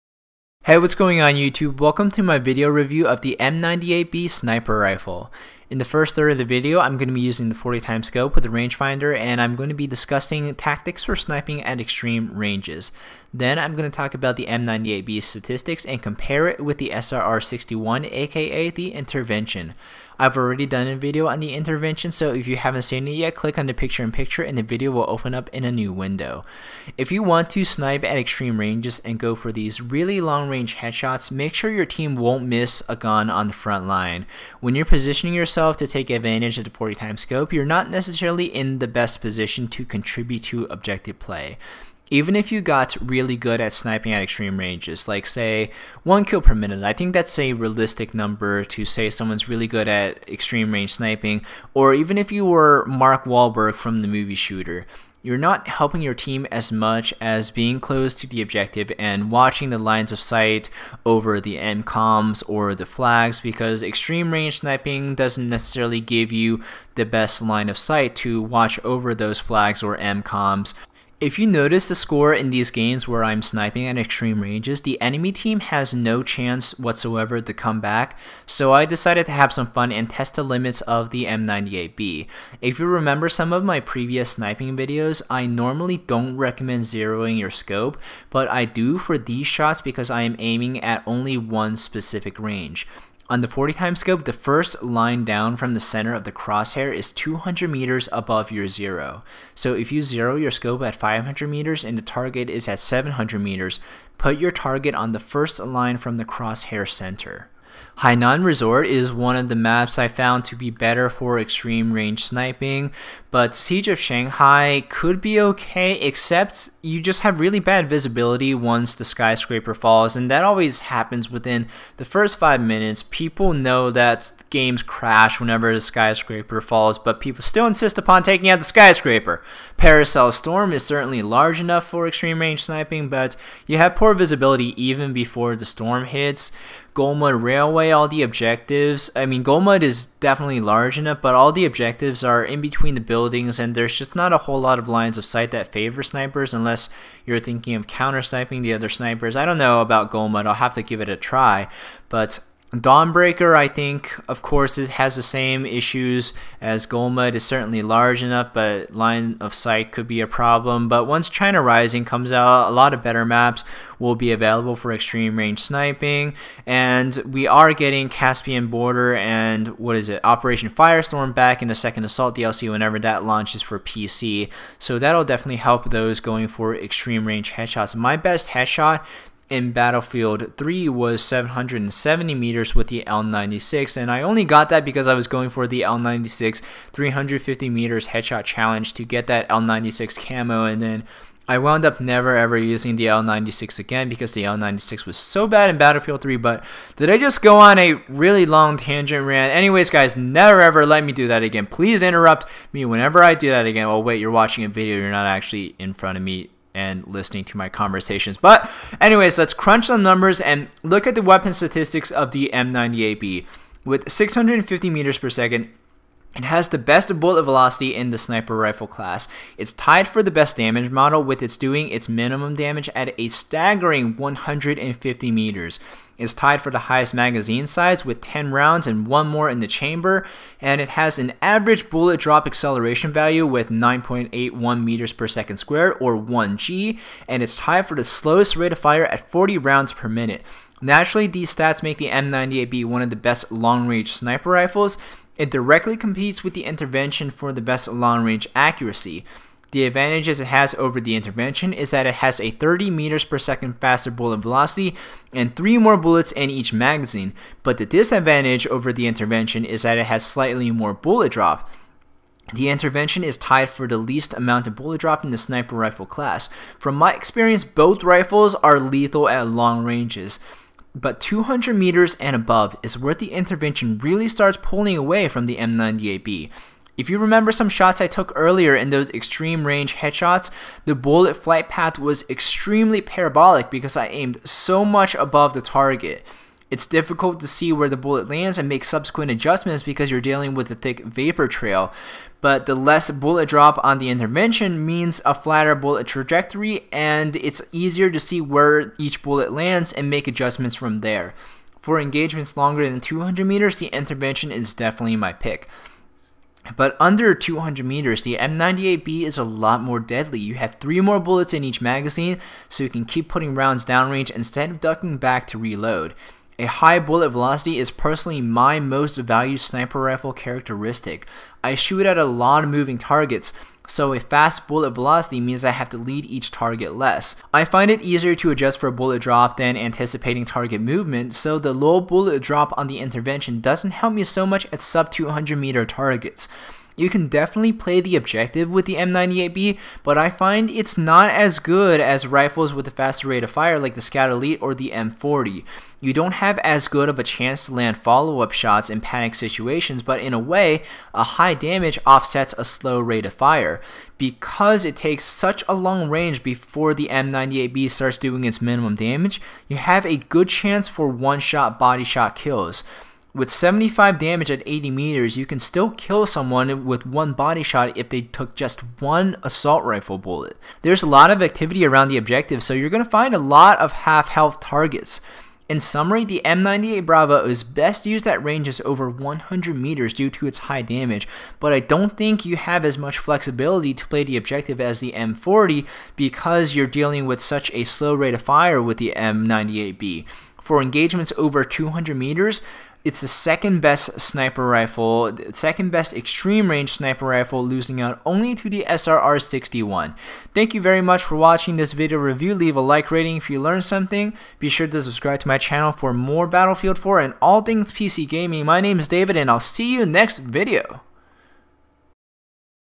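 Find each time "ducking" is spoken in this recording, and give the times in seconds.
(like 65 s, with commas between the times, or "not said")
314 s.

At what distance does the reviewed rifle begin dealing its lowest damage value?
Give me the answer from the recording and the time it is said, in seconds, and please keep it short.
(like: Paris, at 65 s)
150 meters, at 224 s.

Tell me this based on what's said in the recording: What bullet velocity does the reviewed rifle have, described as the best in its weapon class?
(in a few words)
650 meters per second.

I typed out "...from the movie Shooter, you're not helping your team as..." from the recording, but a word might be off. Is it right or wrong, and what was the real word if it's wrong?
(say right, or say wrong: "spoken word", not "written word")
right.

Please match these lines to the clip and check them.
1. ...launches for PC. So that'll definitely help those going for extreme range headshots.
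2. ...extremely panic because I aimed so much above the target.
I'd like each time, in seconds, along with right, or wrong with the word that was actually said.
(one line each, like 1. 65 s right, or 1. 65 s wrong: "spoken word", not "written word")
1. 173 s right
2. 282 s wrong: "parabolic", not "panic".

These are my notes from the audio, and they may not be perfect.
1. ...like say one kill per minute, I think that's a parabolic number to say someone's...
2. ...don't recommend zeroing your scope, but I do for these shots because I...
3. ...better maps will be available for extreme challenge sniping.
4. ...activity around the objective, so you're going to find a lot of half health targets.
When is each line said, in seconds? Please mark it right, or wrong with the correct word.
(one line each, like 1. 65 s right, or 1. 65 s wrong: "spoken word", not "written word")
1. 45 s wrong: "realistic", not "parabolic"
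2. 85 s right
3. 163 s wrong: "range", not "challenge"
4. 371 s right.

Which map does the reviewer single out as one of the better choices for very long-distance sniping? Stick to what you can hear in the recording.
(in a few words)
Hainan Resort.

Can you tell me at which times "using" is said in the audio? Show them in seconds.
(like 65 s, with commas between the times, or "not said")
7 s, 192 s.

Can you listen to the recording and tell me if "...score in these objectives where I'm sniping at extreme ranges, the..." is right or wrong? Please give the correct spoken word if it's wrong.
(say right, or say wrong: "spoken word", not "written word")
wrong: "games", not "objectives".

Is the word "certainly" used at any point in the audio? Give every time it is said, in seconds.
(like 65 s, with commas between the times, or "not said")
130 s, 157 s.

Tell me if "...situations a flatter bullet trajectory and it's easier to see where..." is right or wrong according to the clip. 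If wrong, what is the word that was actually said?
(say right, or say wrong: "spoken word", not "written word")
wrong: "means", not "situations".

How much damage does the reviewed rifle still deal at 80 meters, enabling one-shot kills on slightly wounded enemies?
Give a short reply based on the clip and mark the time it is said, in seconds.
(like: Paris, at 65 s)
75, at 363 s.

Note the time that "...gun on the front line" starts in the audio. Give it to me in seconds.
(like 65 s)
32 s.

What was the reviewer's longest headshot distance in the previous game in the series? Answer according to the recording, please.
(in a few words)
770 meters.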